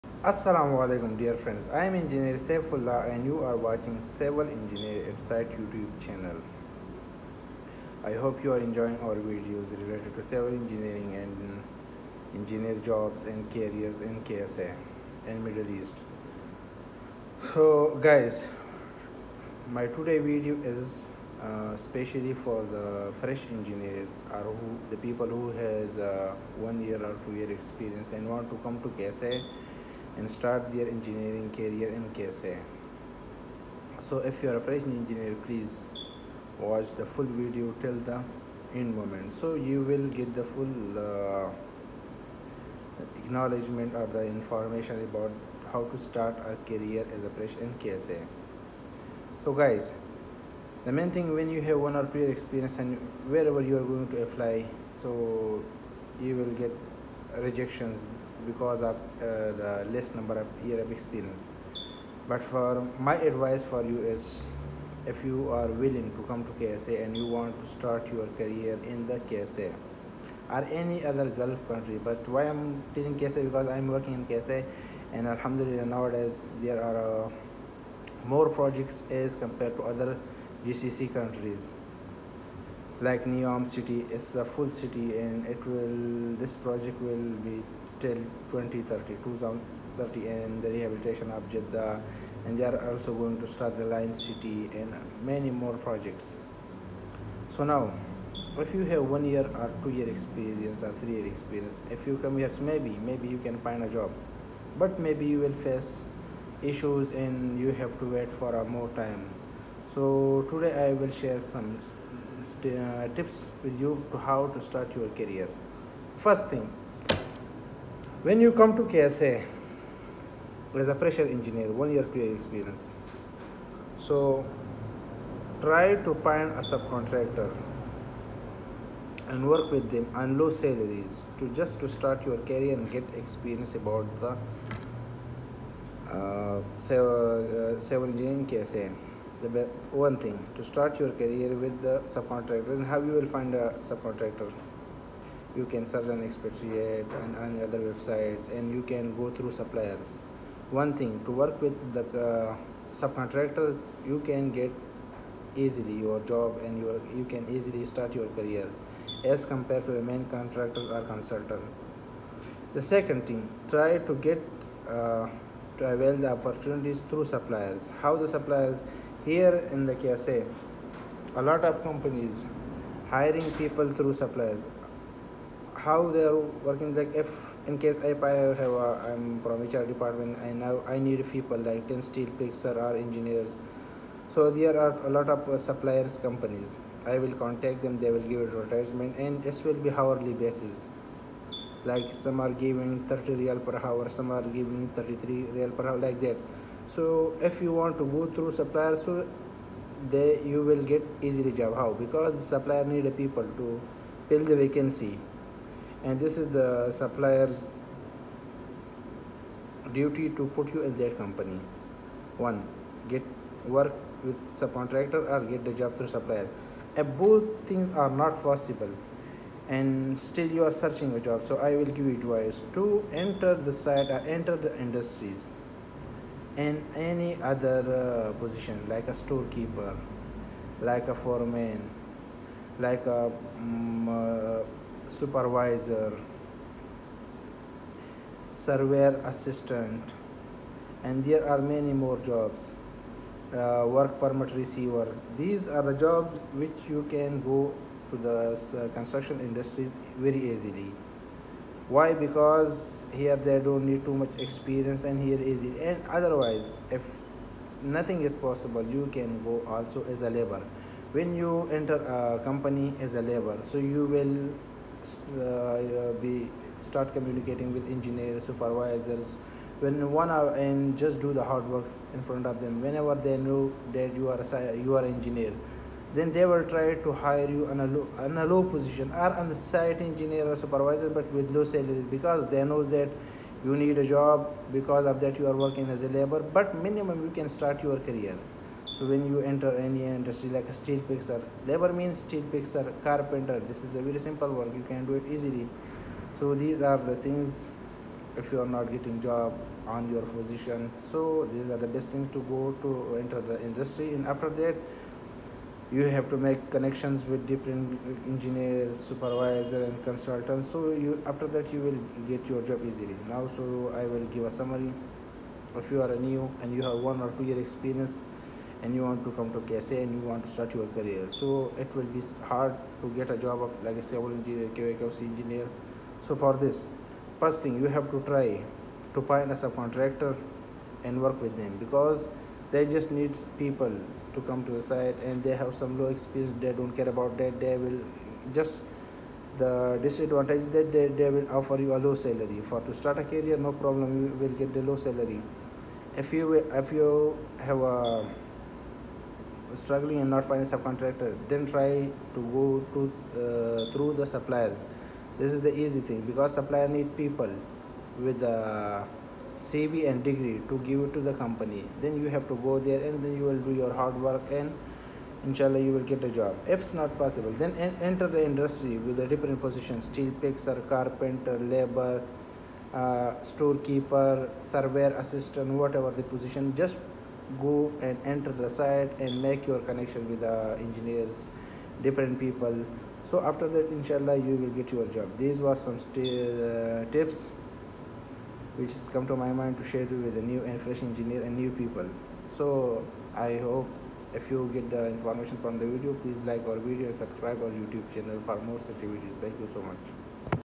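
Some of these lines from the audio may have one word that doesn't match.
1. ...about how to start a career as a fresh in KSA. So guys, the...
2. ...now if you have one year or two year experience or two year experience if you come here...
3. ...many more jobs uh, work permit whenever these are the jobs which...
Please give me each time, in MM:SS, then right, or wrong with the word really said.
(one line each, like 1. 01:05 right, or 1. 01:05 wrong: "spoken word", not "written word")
1. 00:45 right
2. 01:37 wrong: "three", not "two"
3. 04:01 wrong: "receiver", not "whenever".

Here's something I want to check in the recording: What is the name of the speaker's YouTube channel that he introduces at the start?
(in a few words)
Civil Engineer At Site.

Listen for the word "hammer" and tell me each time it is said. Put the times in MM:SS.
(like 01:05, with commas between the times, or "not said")
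not said.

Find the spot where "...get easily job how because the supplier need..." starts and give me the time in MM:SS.
03:20.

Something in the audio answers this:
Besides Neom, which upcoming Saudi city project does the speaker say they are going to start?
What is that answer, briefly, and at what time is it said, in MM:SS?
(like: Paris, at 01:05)
Line City, at 01:33.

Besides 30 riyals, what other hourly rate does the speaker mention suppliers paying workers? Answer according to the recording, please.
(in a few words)
33 riyals per hour.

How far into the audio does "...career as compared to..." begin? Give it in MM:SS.
02:38.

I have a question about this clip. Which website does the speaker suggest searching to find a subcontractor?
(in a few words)
Expatriate.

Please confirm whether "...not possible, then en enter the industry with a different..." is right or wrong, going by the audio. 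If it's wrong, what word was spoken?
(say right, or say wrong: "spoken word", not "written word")
right.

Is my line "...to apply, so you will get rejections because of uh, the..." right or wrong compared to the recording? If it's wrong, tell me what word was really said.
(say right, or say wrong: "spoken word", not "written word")
right.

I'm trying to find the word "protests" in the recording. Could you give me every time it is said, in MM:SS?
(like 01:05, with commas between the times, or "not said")
not said.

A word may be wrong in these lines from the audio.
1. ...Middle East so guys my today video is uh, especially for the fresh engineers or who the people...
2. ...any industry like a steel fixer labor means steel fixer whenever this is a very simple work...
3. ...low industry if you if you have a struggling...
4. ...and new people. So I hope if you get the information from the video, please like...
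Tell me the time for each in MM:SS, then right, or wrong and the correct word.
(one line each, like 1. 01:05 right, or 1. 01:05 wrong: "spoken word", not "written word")
1. 00:15 right
2. 04:49 wrong: "carpenter", not "whenever"
3. 05:44 wrong: "salary", not "industry"
4. 06:31 right.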